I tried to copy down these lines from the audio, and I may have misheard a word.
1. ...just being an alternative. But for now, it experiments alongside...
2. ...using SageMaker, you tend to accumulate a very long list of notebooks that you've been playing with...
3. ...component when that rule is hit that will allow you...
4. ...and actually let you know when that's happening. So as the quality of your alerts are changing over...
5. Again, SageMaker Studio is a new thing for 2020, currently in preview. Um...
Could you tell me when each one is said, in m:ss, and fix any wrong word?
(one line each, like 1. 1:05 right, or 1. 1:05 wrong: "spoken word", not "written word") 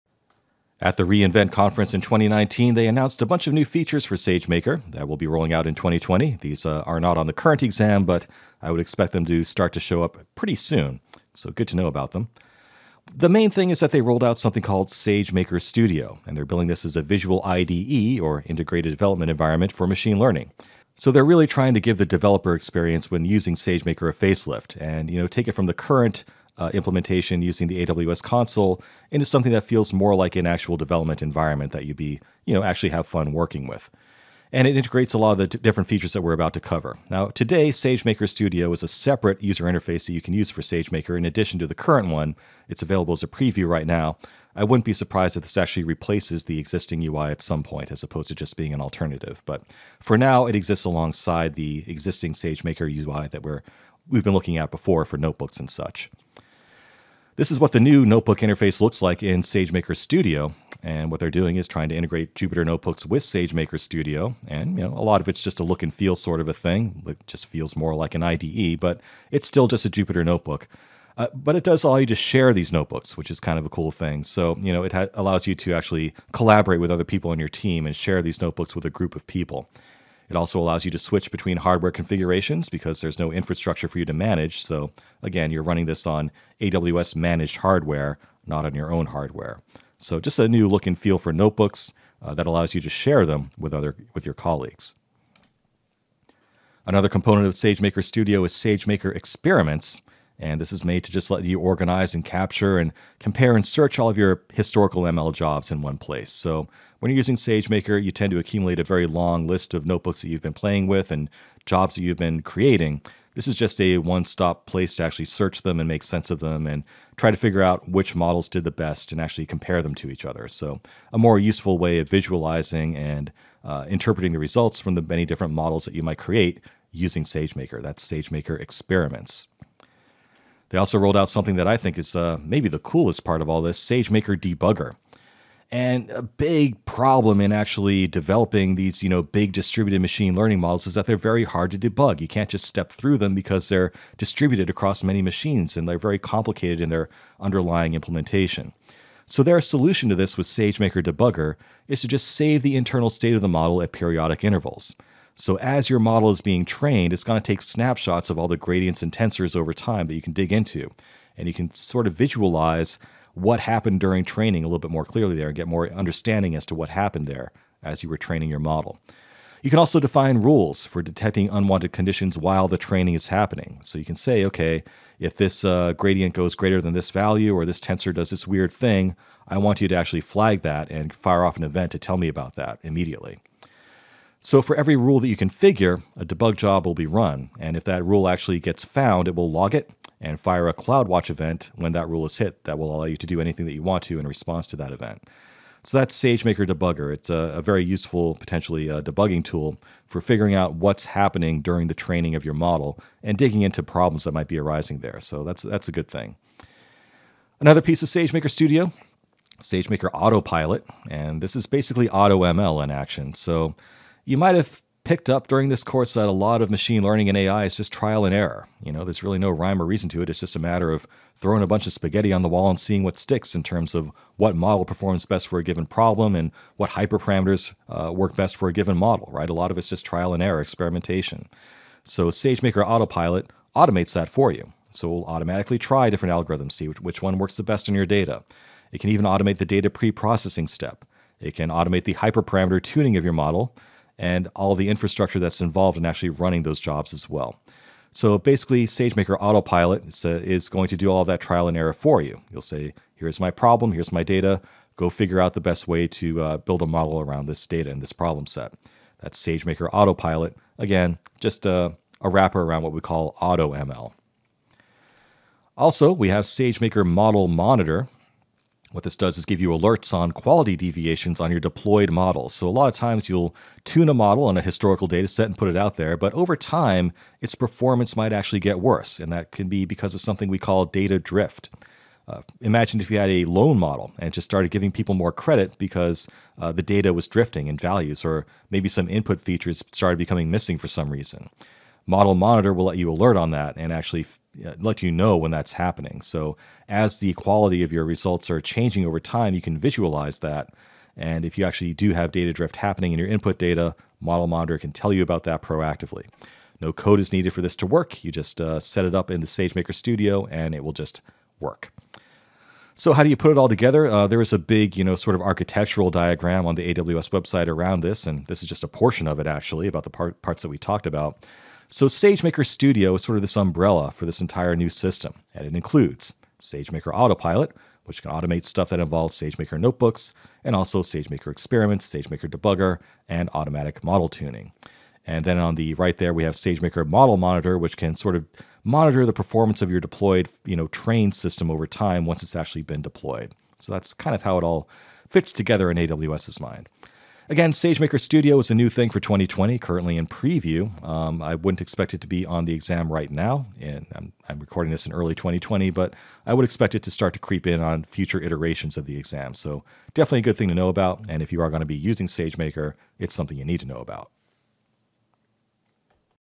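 1. 0:48 wrong: "exists", not "experiments"
2. 1:47 right
3. 3:11 wrong: "event", not "component"
4. 4:53 wrong: "results", not "alerts"
5. 5:47 right.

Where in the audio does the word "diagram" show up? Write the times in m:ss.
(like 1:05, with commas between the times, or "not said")
5:16.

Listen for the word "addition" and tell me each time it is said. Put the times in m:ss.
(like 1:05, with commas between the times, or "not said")
0:41.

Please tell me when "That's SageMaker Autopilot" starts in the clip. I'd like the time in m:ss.
4:19.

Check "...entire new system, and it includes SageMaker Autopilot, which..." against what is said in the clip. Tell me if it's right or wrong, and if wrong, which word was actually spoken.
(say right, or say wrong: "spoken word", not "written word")
right.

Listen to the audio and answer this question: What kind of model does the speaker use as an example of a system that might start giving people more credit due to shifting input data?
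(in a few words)
a loan model.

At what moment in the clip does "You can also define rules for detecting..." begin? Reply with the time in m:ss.
2:49.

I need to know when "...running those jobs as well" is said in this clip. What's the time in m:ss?
4:06.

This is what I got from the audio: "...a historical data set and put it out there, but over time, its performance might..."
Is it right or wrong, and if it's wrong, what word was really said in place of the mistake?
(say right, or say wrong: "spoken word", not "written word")
right.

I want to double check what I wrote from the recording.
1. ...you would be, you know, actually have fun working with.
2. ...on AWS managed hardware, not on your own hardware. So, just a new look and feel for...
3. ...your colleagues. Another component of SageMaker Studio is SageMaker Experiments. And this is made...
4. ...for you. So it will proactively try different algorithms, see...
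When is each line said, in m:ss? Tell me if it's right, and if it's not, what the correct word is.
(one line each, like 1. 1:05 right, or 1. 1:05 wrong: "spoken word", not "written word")
1. 0:31 right
2. 1:26 right
3. 1:34 right
4. 3:54 wrong: "automatically", not "proactively".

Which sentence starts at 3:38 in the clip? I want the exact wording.
You know, there's really no rhyme or reason to it.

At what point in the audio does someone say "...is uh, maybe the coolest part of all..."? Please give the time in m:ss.
2:11.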